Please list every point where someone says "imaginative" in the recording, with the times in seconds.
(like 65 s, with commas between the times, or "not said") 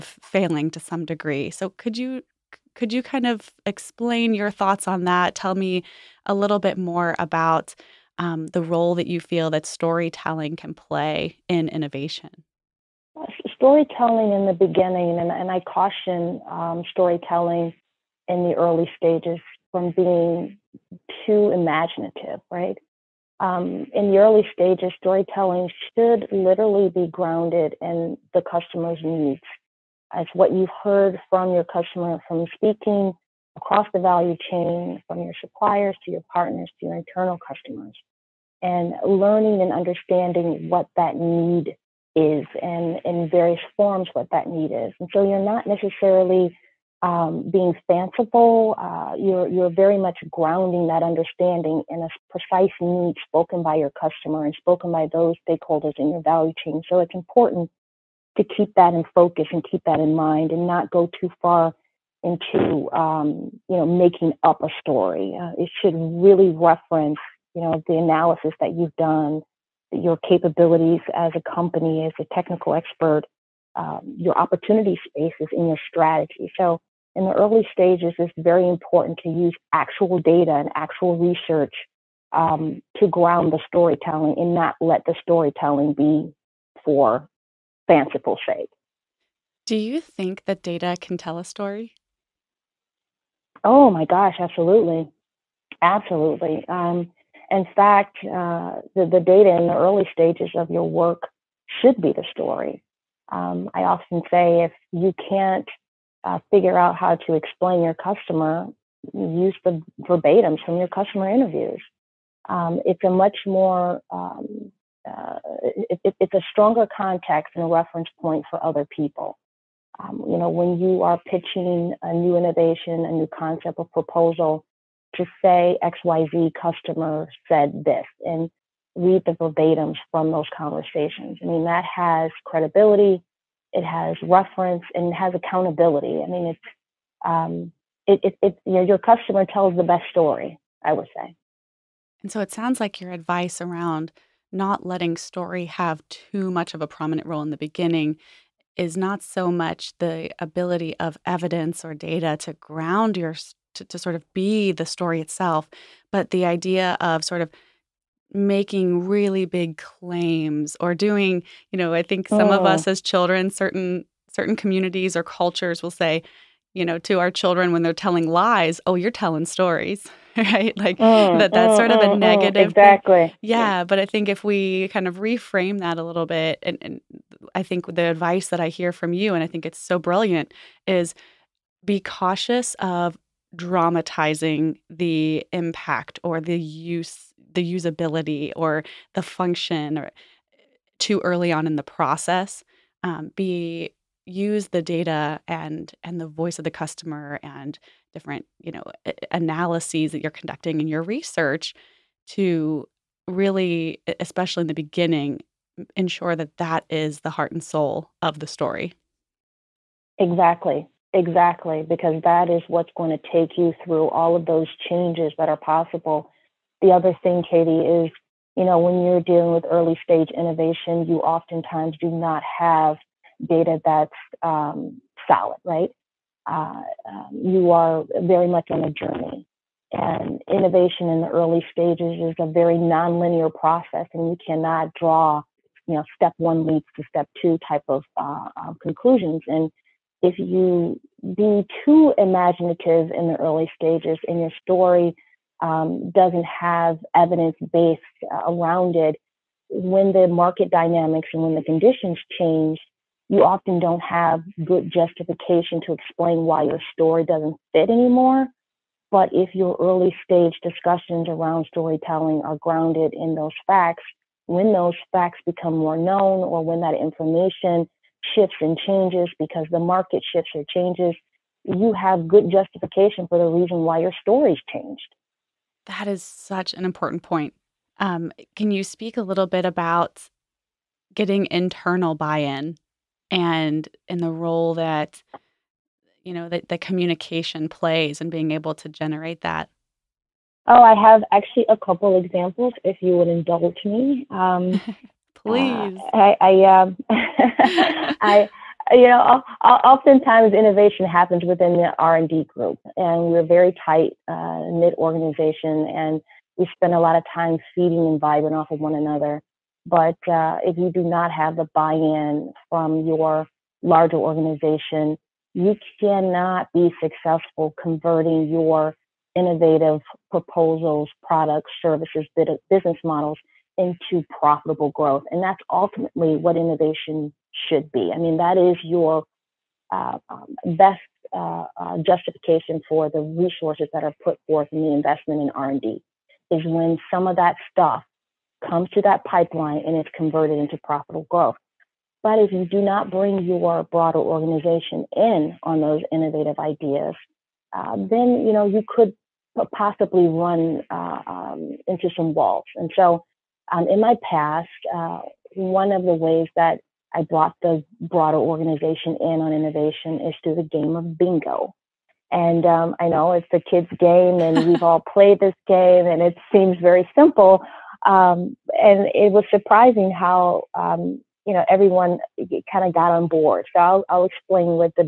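21 s, 242 s.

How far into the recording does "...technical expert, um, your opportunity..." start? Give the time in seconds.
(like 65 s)
72 s.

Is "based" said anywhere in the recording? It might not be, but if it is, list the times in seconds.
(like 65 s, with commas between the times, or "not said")
247 s.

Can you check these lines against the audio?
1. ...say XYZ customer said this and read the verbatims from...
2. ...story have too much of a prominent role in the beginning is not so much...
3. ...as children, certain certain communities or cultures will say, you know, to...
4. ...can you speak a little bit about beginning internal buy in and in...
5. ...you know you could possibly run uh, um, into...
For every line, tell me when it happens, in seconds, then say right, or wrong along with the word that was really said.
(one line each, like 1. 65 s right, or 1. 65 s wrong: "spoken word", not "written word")
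1. 125 s right
2. 145 s right
3. 162 s right
4. 278 s wrong: "getting", not "beginning"
5. 348 s right.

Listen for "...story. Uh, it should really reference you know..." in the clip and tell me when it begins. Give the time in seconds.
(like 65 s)
64 s.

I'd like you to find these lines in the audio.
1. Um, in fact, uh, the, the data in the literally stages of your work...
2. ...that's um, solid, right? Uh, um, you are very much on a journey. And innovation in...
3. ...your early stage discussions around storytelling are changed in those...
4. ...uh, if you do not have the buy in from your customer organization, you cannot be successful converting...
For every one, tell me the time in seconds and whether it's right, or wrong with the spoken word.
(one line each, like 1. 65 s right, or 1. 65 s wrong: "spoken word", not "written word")
1. 96 s wrong: "early", not "literally"
2. 223 s right
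3. 259 s wrong: "grounded", not "changed"
4. 310 s wrong: "larger", not "customer".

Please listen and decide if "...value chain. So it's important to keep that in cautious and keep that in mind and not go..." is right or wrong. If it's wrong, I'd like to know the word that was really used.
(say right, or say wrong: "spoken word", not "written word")
wrong: "focus", not "cautious".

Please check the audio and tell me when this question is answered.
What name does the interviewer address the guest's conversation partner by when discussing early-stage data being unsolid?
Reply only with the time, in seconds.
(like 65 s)
217 s.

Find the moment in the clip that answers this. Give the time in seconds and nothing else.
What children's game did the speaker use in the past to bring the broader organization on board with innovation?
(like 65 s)
361 s.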